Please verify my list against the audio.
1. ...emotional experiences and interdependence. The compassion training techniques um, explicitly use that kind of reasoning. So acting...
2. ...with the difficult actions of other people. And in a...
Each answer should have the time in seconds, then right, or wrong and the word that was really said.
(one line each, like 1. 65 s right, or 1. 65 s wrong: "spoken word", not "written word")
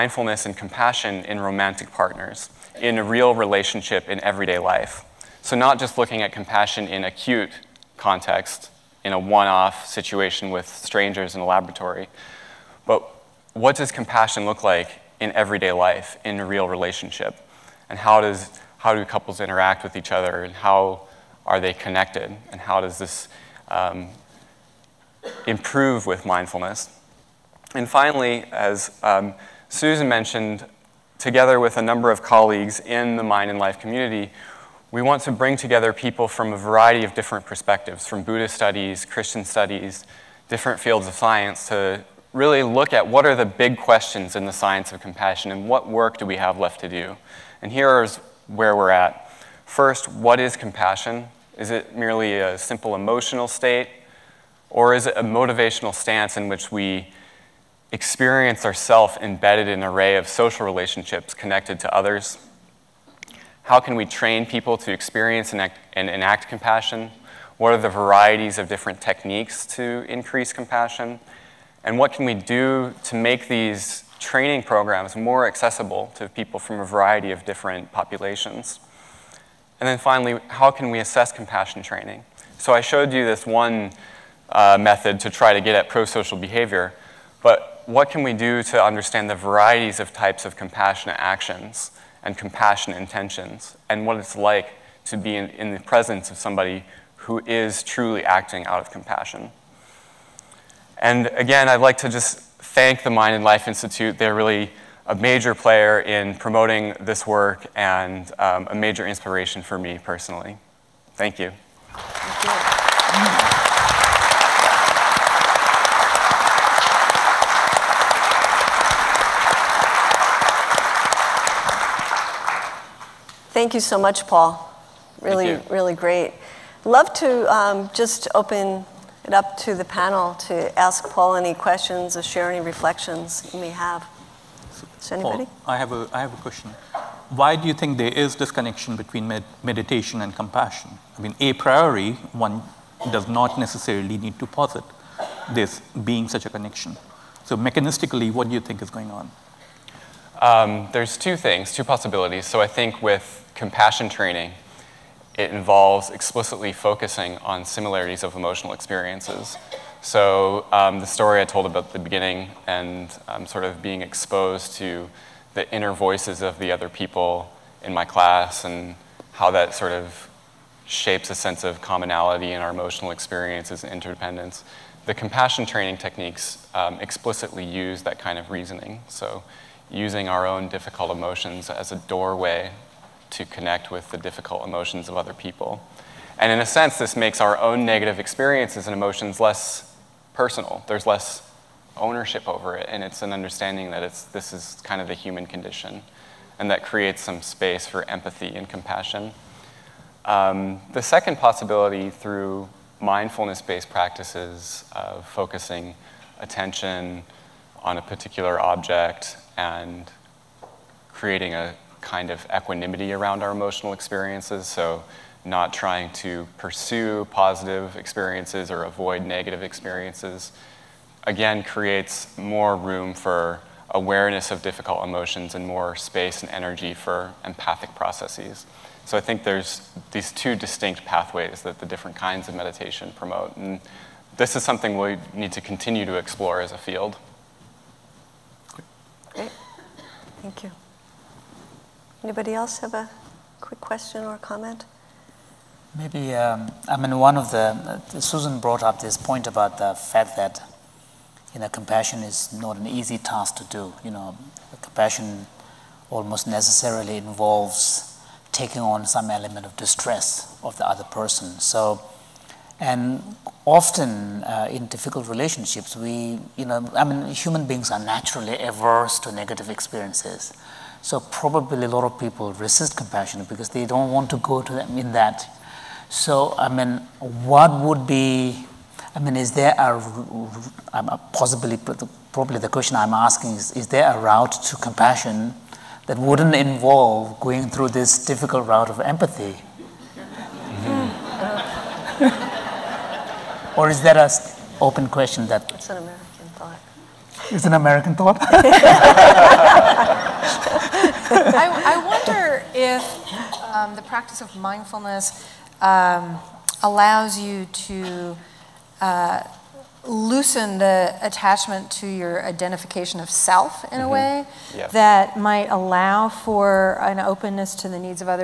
1. 172 s wrong: "using", not "acting"
2. 183 s wrong: "emotions", not "actions".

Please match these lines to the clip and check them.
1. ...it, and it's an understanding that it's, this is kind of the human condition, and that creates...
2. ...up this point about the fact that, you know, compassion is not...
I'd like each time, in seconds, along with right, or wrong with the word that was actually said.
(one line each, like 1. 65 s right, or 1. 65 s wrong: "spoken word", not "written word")
1. 192 s right
2. 248 s right.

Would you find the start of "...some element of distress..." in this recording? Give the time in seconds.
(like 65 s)
259 s.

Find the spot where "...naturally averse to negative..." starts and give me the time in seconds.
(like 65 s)
267 s.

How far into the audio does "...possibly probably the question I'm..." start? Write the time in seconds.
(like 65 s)
281 s.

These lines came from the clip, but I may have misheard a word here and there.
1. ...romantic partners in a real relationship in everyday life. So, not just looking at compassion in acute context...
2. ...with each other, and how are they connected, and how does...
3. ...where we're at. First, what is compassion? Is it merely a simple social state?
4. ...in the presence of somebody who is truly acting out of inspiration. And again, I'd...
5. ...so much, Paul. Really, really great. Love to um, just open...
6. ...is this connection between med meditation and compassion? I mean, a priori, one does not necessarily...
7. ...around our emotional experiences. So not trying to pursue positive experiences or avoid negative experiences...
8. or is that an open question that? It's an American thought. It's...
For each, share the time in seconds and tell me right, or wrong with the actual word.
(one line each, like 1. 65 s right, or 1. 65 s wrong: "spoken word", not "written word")
1. 1 s right
2. 19 s right
3. 48 s wrong: "emotional", not "social"
4. 95 s wrong: "compassion", not "inspiration"
5. 123 s right
6. 138 s right
7. 213 s right
8. 293 s right.